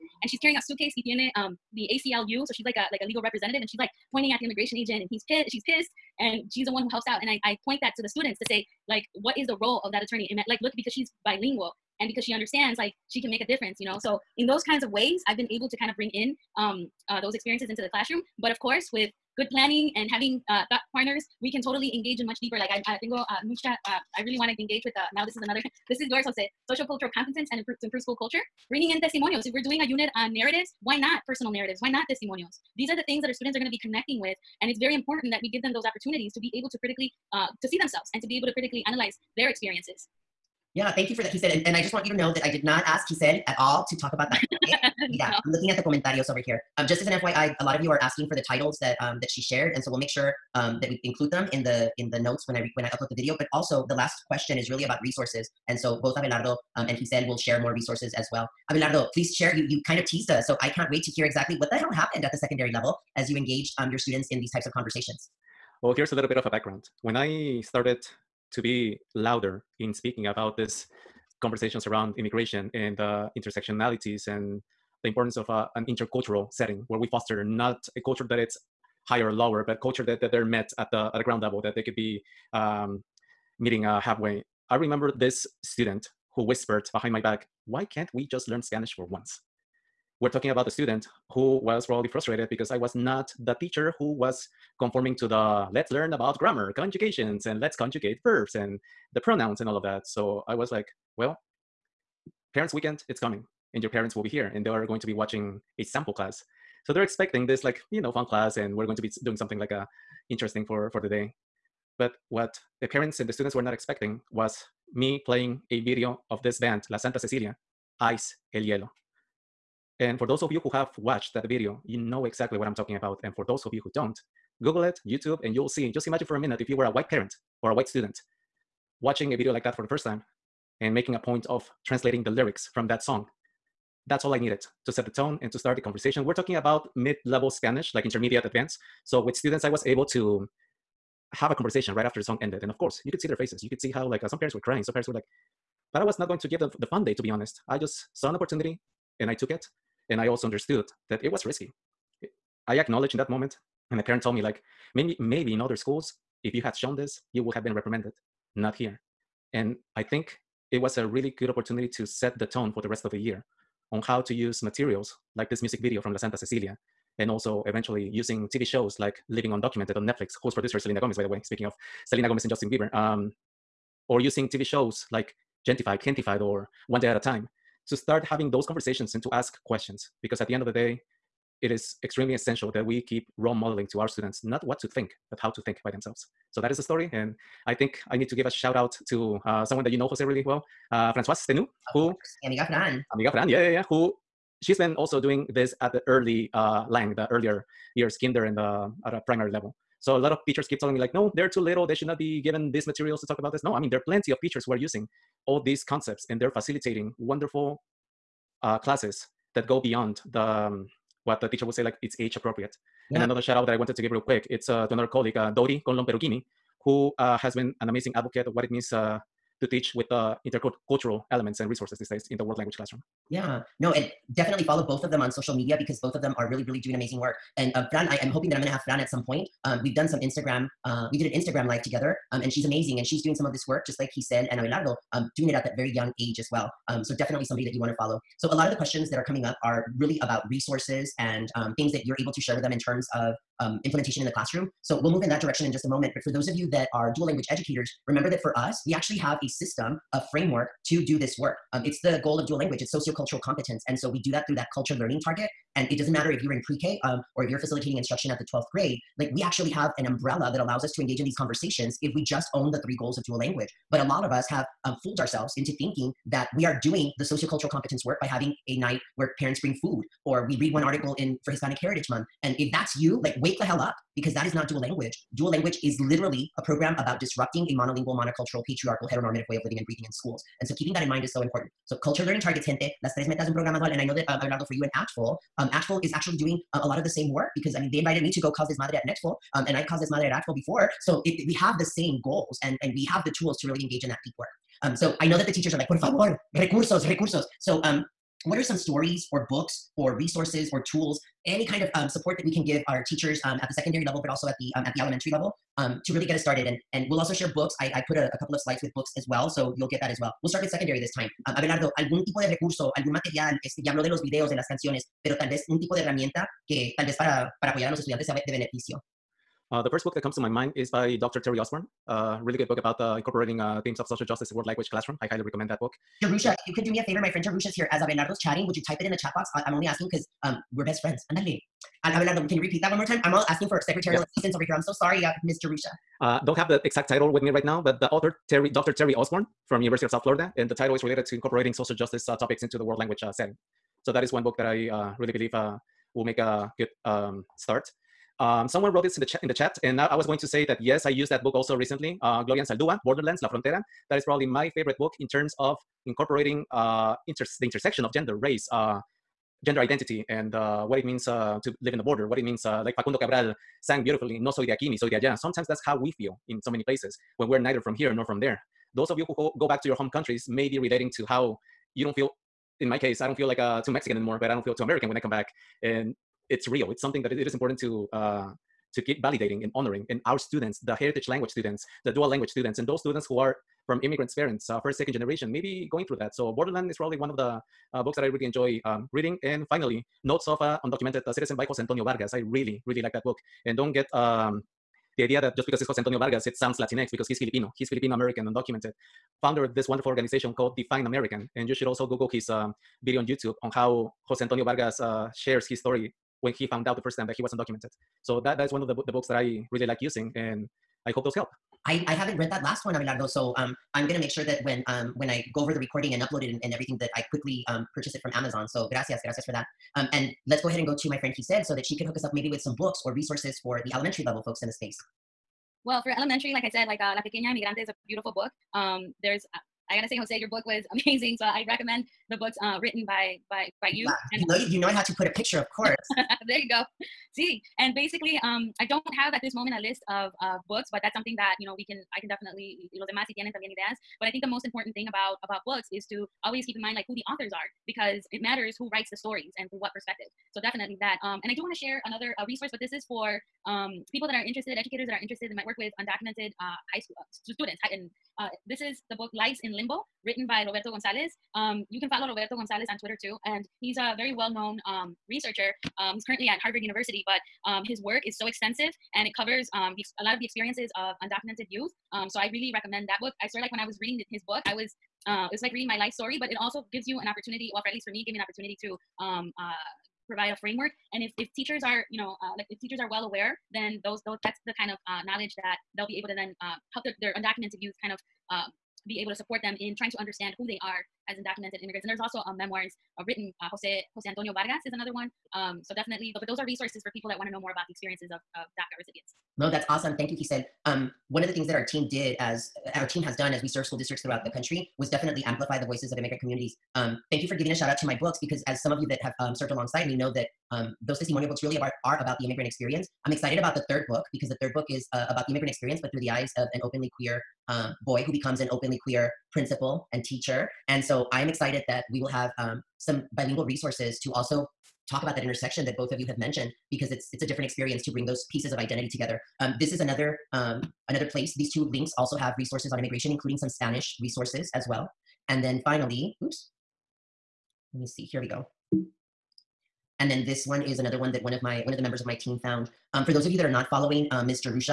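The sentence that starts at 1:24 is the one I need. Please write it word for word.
I remember this student who whispered behind my back, why can't we just learn Spanish for once?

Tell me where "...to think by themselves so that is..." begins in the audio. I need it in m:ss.
3:05.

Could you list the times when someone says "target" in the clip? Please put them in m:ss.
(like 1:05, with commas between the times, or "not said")
4:15, 4:42.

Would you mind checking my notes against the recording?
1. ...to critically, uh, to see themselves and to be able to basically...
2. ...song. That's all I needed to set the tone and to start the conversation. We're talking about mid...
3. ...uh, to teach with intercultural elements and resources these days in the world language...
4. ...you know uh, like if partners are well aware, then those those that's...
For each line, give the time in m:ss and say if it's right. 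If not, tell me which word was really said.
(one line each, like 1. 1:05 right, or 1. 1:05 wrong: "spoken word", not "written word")
1. 0:36 wrong: "critically", not "basically"
2. 2:13 right
3. 3:38 right
4. 8:02 wrong: "teachers", not "partners".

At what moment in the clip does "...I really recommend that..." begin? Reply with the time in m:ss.
7:52.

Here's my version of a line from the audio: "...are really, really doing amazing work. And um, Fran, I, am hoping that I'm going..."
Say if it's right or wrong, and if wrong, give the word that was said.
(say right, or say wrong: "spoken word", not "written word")
right.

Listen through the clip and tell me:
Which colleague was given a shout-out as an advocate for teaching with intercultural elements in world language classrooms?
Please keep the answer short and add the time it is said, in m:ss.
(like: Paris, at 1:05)
Dori Conlon Perugini, at 3:35.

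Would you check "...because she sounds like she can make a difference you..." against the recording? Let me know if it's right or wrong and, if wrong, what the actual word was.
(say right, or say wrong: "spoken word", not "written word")
wrong: "understands", not "sounds".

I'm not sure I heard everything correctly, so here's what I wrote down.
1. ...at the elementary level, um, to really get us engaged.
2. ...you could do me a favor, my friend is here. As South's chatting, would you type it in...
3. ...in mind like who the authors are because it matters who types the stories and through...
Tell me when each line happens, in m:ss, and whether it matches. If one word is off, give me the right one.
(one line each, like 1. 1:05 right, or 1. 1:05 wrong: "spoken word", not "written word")
1. 5:04 wrong: "started", not "engaged"
2. 5:26 wrong: "Abelardo", not "South"
3. 7:26 wrong: "writes", not "types".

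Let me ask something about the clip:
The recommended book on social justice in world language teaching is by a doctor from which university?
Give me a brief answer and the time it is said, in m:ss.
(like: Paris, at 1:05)
University of South Florida, at 5:39.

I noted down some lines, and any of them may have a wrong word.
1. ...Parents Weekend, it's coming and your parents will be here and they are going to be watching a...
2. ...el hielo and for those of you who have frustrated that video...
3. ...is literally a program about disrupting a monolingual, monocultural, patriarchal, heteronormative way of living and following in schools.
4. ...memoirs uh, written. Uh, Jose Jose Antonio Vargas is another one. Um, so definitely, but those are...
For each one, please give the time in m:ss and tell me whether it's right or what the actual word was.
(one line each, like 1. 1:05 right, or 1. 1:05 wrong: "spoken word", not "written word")
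1. 1:42 right
2. 1:58 wrong: "watched", not "frustrated"
3. 4:35 wrong: "breathing", not "following"
4. 8:12 right.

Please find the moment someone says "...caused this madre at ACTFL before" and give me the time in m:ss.
4:49.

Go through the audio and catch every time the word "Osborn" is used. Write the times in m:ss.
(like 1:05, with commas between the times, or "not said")
5:21, 5:39.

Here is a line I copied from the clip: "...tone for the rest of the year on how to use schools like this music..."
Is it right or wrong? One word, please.
wrong.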